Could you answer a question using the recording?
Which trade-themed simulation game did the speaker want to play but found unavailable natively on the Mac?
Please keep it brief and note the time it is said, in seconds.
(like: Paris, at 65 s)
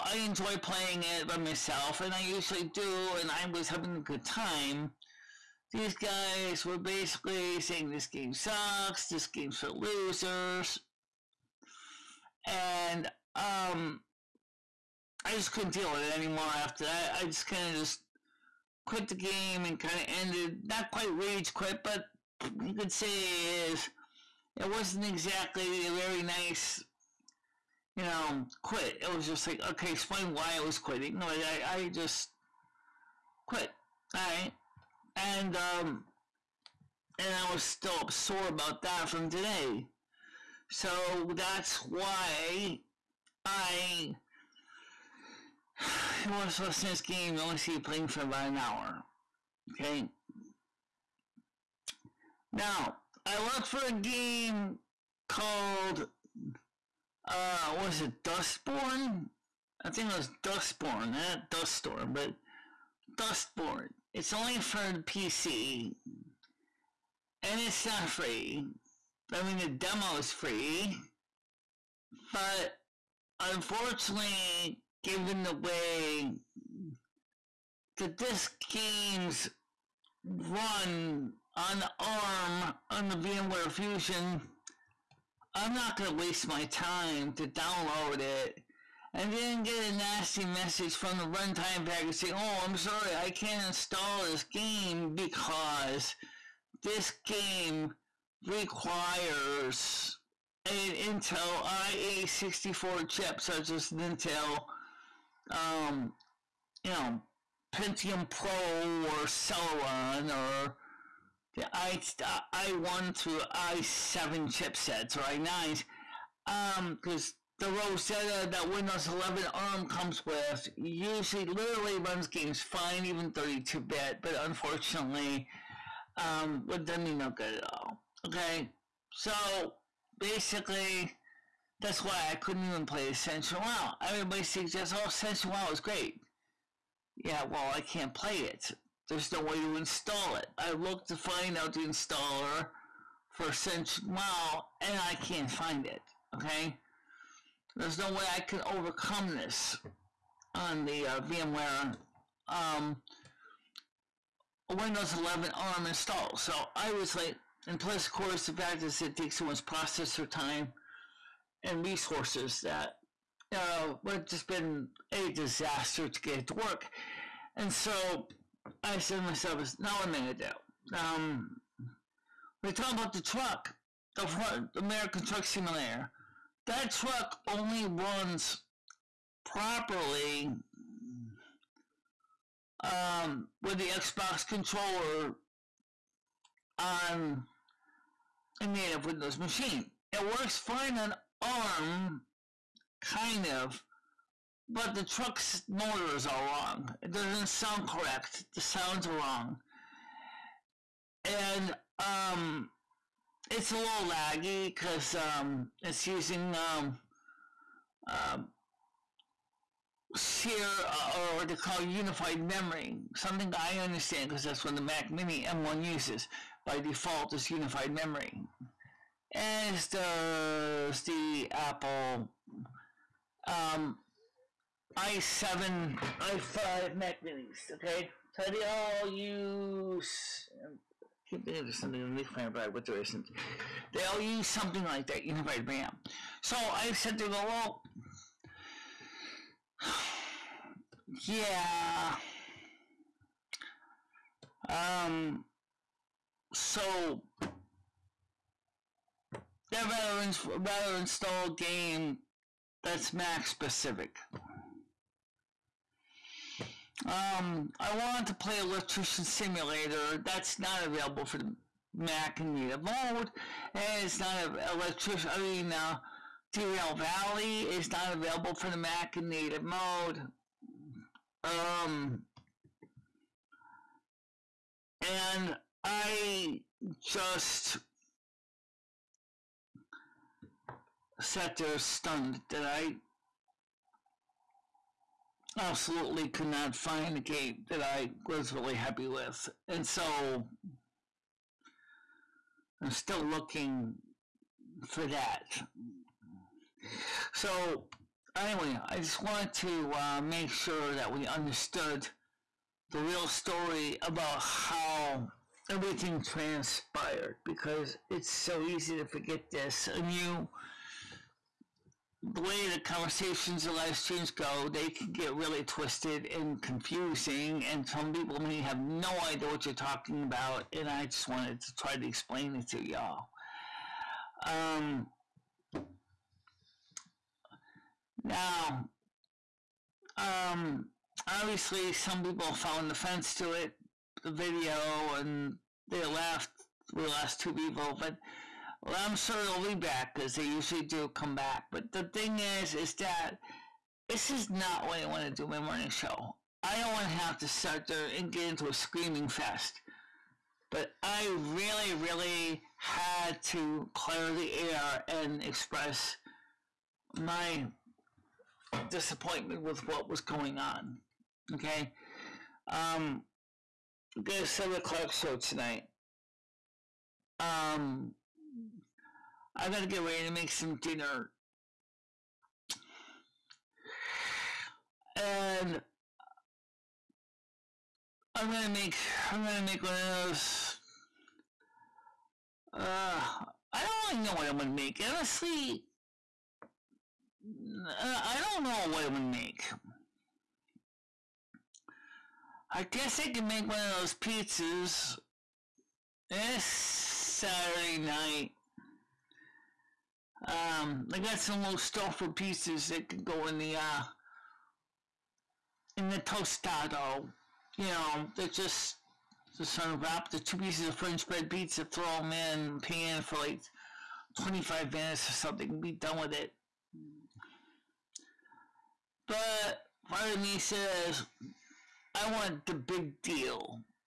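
Electrician Simulator, at 258 s.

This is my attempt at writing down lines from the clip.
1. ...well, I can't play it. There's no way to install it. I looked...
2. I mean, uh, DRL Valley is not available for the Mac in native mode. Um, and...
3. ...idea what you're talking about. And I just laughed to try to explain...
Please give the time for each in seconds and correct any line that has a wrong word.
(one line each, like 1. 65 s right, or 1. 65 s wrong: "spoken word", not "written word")
1. 137 s right
2. 265 s right
3. 319 s wrong: "wanted", not "laughed".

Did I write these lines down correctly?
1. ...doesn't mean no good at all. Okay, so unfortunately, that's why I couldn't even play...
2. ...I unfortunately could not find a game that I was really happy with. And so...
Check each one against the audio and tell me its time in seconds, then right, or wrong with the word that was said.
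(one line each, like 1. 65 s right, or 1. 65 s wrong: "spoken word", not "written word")
1. 126 s wrong: "basically", not "unfortunately"
2. 282 s wrong: "absolutely", not "unfortunately".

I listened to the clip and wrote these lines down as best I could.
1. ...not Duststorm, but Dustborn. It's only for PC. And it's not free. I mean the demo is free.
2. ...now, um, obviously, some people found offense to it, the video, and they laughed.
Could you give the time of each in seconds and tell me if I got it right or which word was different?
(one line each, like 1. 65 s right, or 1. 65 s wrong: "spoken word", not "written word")
1. 61 s right
2. 328 s right.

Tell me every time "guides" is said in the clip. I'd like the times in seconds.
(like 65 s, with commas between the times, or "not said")
not said.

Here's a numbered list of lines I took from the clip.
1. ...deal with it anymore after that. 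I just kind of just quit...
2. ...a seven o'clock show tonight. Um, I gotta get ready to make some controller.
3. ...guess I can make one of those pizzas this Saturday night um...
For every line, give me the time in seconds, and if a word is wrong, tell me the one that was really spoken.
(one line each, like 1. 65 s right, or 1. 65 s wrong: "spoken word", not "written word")
1. 15 s right
2. 364 s wrong: "dinner", not "controller"
3. 392 s right.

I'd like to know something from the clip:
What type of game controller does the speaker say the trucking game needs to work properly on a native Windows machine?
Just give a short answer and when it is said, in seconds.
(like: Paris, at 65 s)
Xbox controller, at 183 s.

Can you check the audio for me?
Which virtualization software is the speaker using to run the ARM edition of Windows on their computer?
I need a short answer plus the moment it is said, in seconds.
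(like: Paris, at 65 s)
VMware Fusion, at 83 s.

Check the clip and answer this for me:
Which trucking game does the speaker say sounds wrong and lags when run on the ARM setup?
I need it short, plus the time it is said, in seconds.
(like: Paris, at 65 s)
American Truck Simulator, at 174 s.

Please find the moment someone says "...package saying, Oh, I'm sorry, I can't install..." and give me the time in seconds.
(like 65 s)
91 s.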